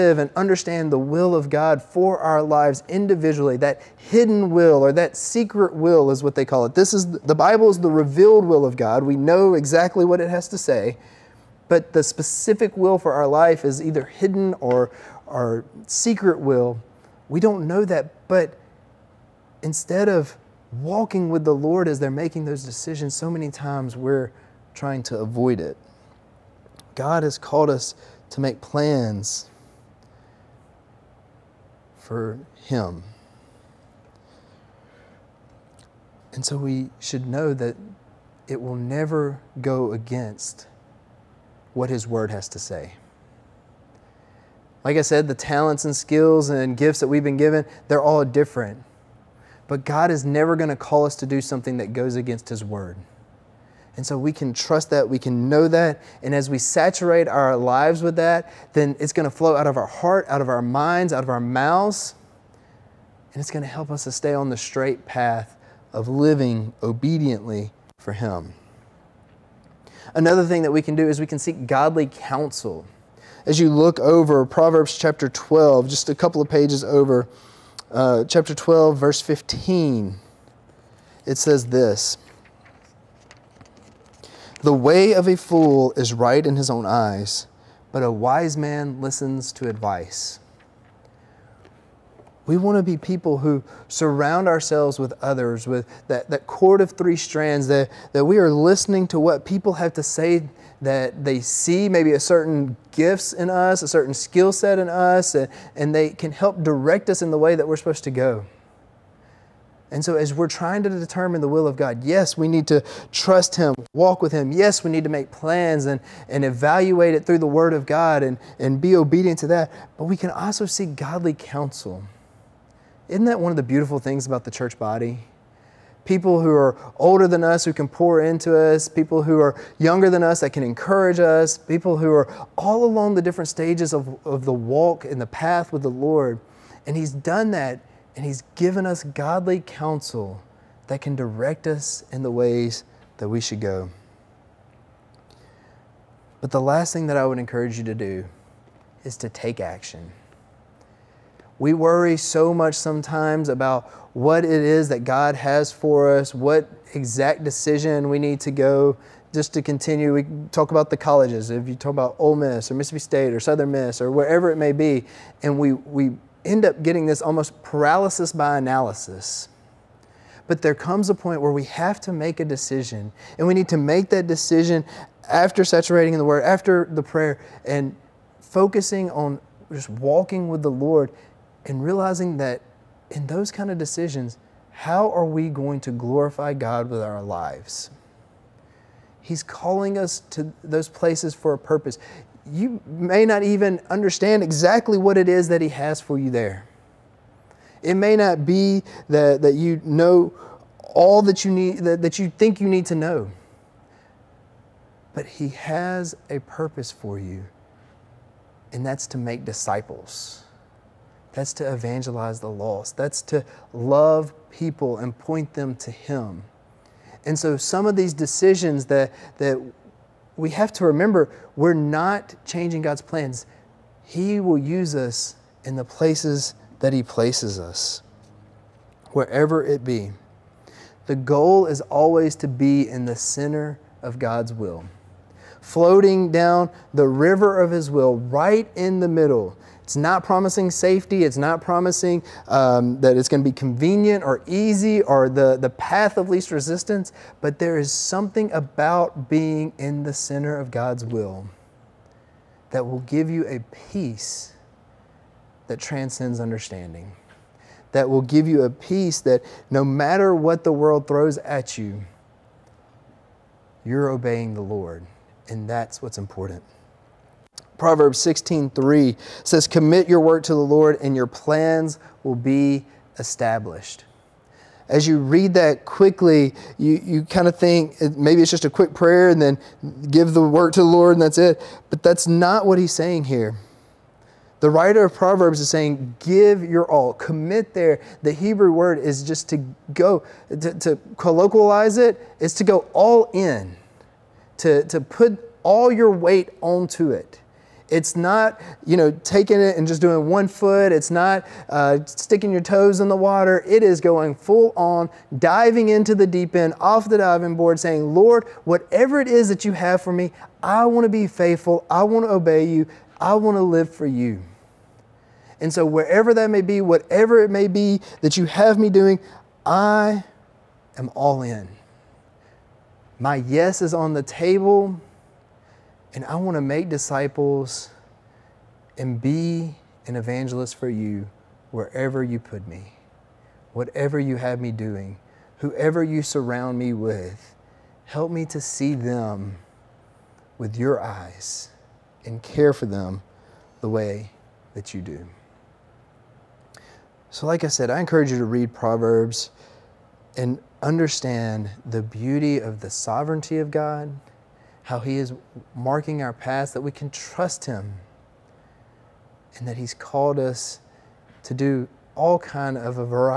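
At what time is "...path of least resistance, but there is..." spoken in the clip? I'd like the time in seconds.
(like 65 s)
245 s.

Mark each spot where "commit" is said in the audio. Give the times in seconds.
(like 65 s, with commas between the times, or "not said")
269 s, 287 s.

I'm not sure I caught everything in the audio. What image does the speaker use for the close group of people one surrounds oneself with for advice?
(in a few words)
cord of three strands.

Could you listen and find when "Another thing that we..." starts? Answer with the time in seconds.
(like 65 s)
70 s.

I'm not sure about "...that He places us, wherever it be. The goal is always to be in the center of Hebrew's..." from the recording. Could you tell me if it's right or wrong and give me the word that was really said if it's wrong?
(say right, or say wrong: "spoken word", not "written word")
wrong: "God", not "Hebrew".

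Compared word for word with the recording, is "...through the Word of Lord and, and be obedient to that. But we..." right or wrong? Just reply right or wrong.
wrong.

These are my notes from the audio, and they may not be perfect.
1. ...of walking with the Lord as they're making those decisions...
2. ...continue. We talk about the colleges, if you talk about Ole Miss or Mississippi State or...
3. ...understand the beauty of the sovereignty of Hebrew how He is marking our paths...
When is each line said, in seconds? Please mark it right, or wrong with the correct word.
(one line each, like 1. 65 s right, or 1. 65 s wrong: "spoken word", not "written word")
1. 20 s right
2. 159 s right
3. 350 s wrong: "God", not "Hebrew".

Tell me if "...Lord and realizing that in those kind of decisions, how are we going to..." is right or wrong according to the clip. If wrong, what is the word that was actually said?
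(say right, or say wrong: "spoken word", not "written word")
right.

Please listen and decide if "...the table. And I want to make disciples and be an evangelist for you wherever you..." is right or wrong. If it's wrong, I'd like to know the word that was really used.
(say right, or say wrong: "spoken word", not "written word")
right.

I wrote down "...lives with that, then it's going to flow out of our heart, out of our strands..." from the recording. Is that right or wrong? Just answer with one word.
wrong.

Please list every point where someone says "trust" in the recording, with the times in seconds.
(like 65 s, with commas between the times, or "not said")
54 s, 113 s, 357 s.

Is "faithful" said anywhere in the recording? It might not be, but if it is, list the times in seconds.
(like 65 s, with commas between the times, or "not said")
311 s.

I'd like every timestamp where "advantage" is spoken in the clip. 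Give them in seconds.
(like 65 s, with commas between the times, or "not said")
not said.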